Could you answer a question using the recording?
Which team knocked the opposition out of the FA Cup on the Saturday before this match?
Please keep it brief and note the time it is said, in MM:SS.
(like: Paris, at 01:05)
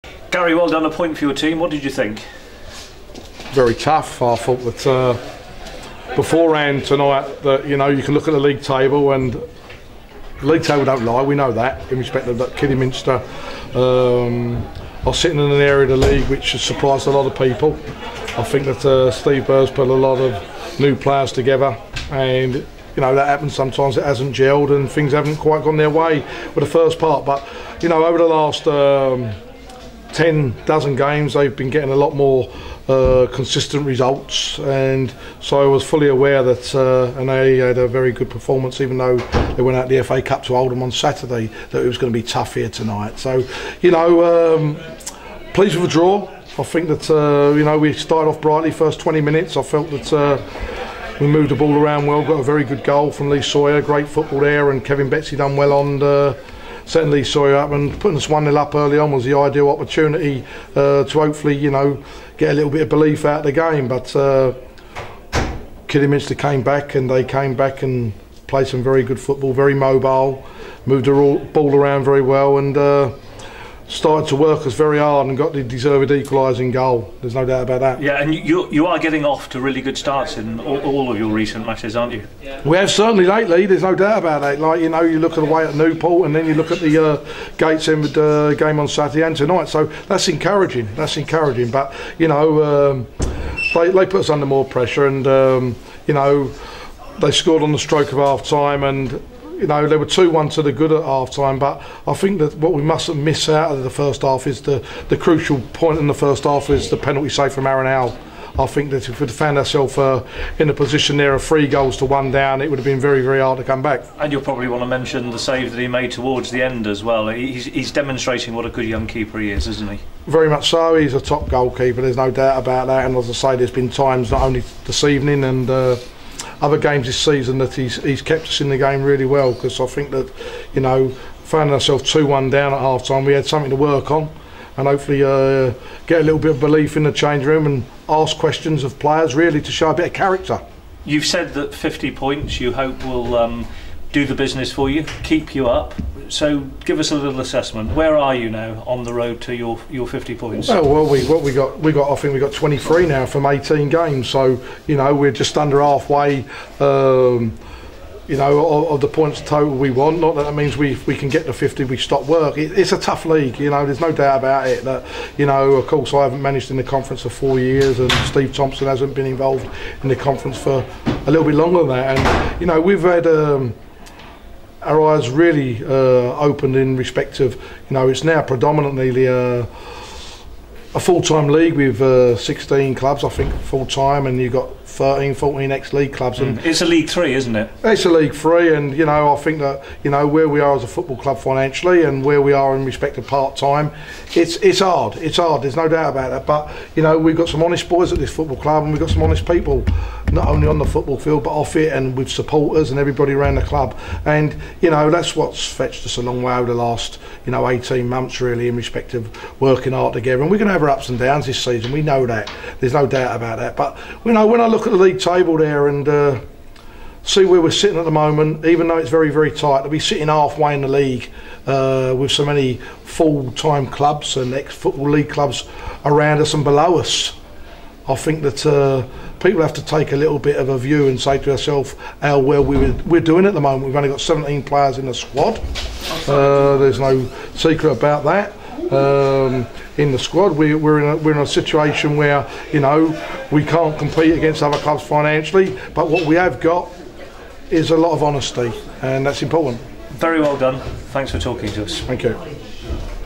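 Oldham, at 00:40.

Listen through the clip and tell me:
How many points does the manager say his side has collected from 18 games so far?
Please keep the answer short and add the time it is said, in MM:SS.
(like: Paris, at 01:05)
23, at 02:32.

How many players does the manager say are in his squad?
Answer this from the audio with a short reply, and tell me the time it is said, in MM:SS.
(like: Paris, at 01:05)
17, at 03:54.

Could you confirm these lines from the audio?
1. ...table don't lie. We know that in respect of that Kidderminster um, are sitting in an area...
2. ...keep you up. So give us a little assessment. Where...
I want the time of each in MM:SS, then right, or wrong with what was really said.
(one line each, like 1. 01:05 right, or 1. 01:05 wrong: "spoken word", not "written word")
1. 00:10 right
2. 02:25 right.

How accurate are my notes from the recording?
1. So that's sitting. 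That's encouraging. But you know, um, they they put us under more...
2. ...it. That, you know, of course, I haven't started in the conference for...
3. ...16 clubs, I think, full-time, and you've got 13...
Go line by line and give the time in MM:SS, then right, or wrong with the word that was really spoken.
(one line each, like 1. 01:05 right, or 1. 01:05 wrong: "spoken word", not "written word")
1. 01:29 wrong: "encouraging", not "sitting"
2. 02:44 wrong: "managed", not "started"
3. 03:02 right.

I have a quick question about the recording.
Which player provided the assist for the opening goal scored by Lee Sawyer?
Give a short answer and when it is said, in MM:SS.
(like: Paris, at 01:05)
Kevin Betsy, at 00:54.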